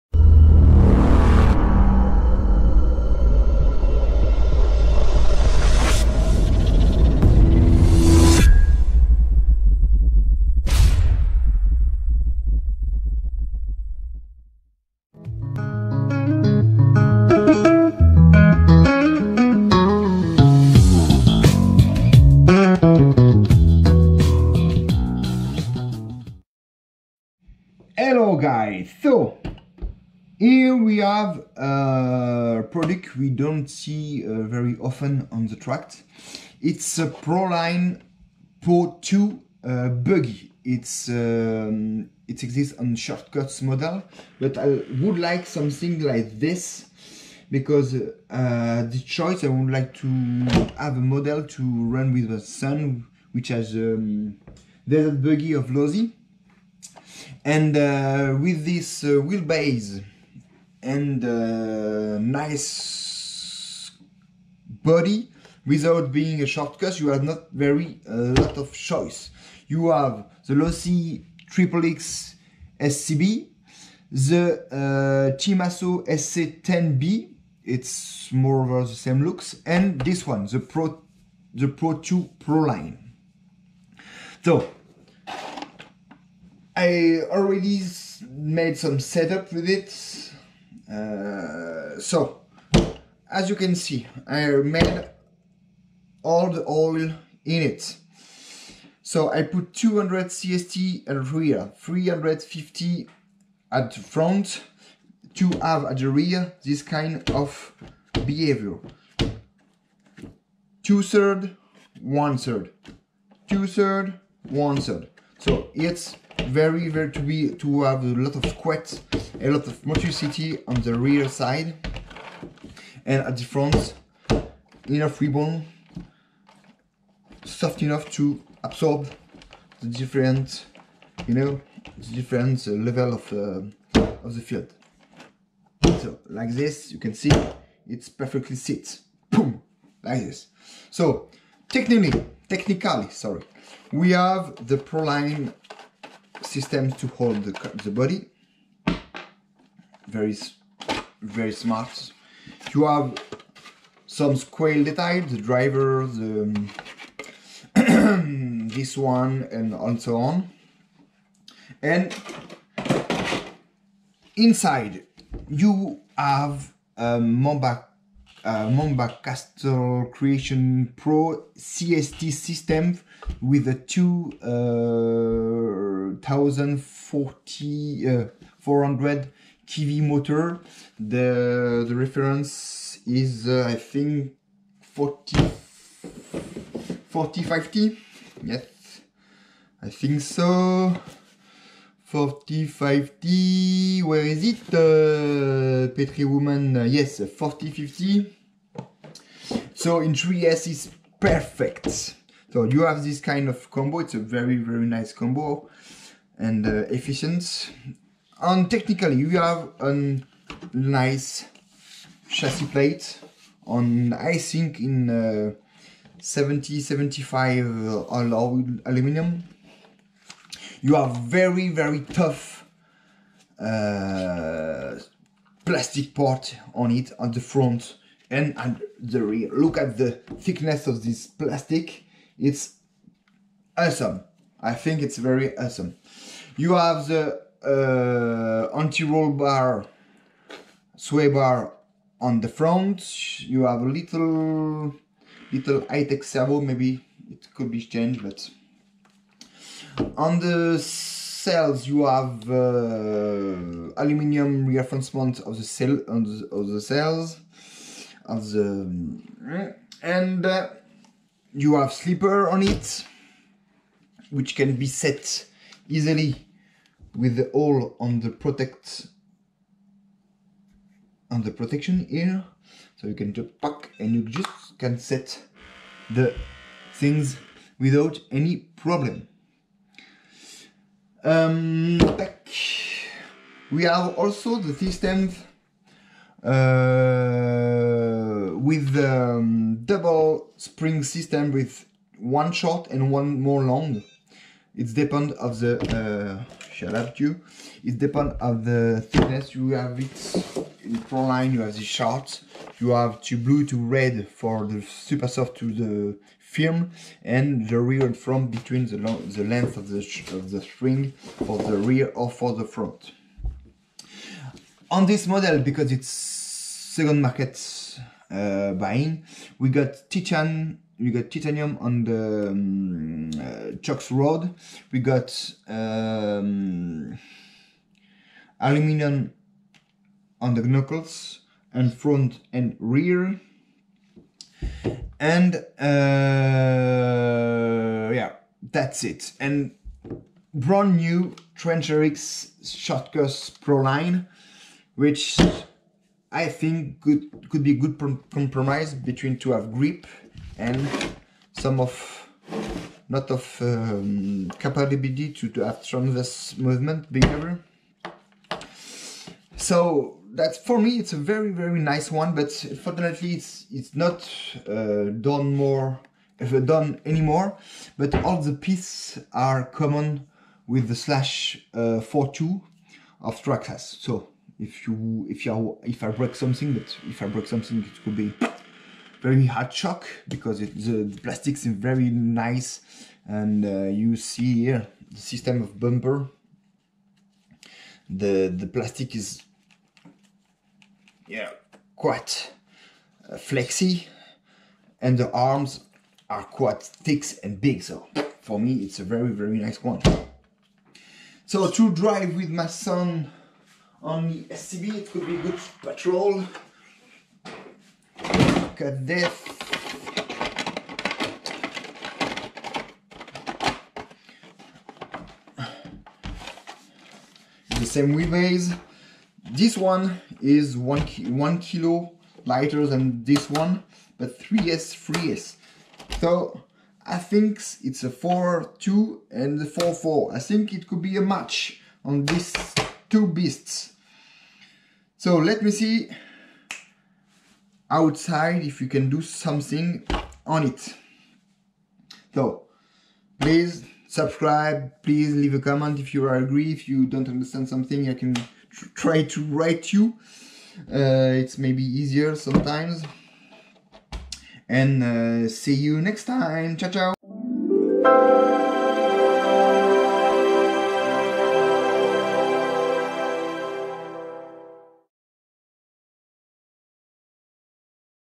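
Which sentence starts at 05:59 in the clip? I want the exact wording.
So that's for me it's a very very nice one, but unfortunately it's it's not uh, done more uh, done anymore.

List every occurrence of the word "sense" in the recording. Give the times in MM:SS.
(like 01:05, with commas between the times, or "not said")
not said.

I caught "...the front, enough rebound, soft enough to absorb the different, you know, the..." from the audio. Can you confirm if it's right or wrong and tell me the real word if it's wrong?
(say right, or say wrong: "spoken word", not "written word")
right.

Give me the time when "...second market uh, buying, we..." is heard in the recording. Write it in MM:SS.
05:16.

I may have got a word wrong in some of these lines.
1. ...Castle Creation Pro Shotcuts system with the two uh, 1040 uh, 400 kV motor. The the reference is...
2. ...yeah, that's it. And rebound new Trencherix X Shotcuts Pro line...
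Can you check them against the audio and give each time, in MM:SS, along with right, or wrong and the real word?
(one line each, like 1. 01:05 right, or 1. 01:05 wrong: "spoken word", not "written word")
1. 02:49 wrong: "CST", not "Shotcuts"
2. 05:38 wrong: "brand", not "rebound".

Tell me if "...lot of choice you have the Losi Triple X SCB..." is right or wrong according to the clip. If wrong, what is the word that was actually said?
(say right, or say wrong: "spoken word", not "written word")
right.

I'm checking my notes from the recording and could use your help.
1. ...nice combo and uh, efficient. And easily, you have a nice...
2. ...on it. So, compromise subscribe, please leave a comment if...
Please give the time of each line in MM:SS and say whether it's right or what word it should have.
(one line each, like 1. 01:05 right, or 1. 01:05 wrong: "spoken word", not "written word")
1. 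03:24 wrong: "technically", not "easily"
2. 07:20 wrong: "please", not "compromise".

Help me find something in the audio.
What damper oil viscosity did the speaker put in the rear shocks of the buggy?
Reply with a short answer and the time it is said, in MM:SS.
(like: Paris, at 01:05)
200 CST, at 01:39.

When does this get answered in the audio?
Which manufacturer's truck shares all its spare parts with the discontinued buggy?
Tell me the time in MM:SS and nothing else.
06:13.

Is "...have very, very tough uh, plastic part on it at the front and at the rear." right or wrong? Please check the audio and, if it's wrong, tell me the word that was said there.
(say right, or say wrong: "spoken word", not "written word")
right.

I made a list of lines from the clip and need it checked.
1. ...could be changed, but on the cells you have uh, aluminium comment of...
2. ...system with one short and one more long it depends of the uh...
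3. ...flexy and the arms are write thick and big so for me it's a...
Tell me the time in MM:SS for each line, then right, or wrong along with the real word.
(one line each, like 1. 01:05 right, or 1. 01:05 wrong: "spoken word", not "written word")
1. 04:07 wrong: "reinforcement", not "comment"
2. 04:51 right
3. 06:33 wrong: "quite", not "write".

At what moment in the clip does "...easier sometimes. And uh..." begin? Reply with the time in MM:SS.
07:31.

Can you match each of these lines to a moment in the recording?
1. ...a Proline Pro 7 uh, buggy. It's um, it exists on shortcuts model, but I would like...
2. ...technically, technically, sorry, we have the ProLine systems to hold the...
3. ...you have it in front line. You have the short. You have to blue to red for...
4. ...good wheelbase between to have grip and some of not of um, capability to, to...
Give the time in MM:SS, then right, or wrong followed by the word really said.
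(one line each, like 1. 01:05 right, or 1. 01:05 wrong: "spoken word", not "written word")
1. 00:36 wrong: "2", not "7"
2. 02:21 right
3. 04:59 right
4. 05:47 wrong: "compromise", not "wheelbase".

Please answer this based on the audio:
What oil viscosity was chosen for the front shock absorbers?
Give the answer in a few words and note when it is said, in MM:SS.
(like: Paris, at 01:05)
350, at 01:41.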